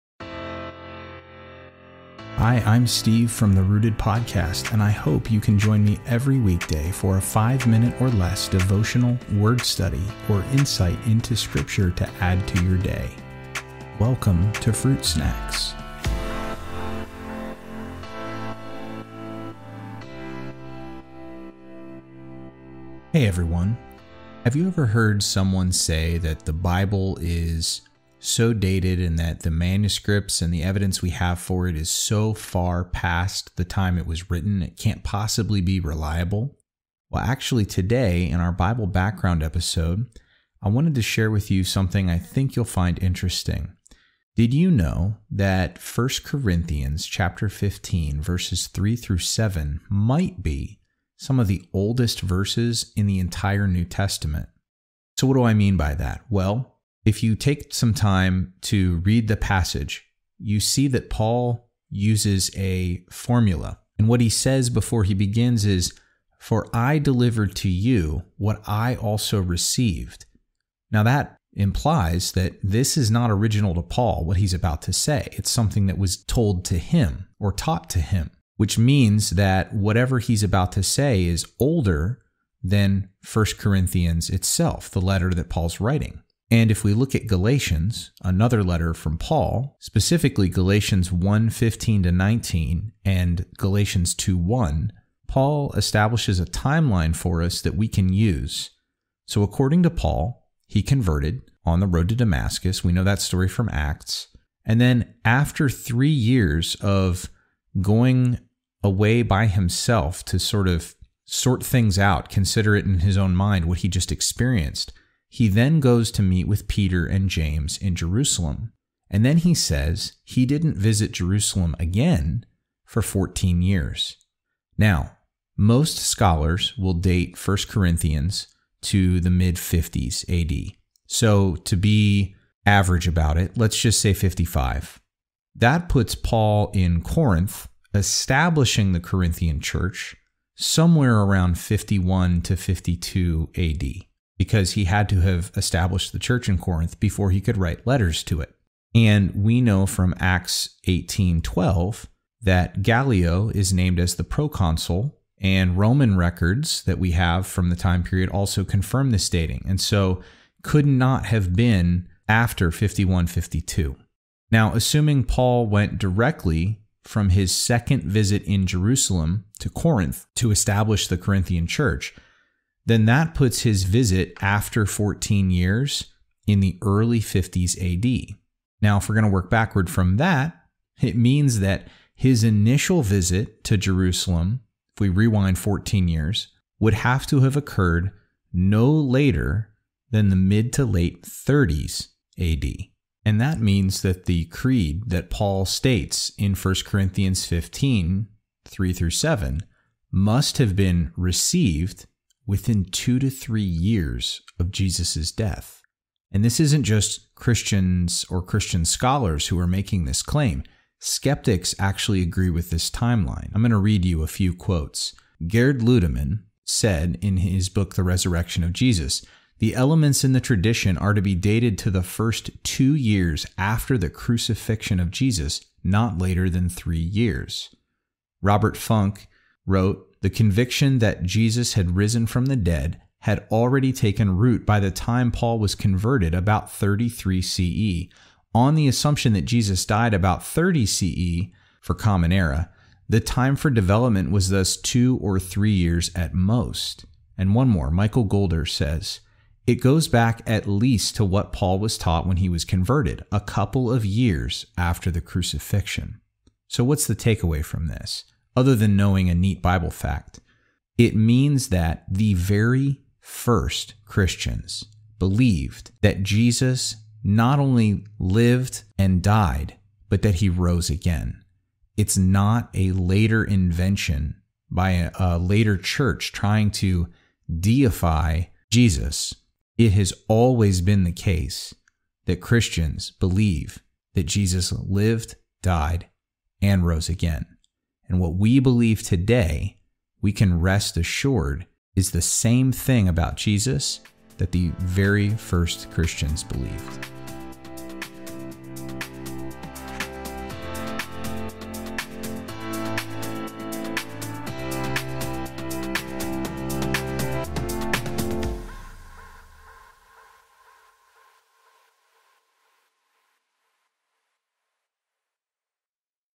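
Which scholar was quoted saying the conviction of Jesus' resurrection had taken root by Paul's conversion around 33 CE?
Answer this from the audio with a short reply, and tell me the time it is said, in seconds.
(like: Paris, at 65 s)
Robert Funk, at 228 s.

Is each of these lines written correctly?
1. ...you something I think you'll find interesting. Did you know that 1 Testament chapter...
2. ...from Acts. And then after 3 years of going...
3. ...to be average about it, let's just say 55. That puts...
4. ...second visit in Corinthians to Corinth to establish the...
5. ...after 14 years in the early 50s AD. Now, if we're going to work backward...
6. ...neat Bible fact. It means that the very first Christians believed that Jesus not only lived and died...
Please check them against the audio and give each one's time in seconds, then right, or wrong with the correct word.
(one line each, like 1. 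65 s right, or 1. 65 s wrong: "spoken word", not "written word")
1. 41 s wrong: "Corinthians", not "Testament"
2. 103 s right
3. 131 s right
4. 167 s wrong: "Jerusalem", not "Corinthians"
5. 174 s right
6. 259 s right.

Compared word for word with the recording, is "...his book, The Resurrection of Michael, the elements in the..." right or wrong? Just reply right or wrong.
wrong.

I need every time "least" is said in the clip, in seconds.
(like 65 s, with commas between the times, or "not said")
250 s.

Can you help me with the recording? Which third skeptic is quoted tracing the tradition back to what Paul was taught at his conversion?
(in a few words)
Michael Goulder.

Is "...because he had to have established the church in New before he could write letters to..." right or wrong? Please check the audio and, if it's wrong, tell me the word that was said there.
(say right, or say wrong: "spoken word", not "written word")
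wrong: "Corinth", not "New".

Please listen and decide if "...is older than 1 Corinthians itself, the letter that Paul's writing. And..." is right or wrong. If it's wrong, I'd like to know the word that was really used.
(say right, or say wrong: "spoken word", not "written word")
right.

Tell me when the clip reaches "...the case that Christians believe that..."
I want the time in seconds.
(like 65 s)
281 s.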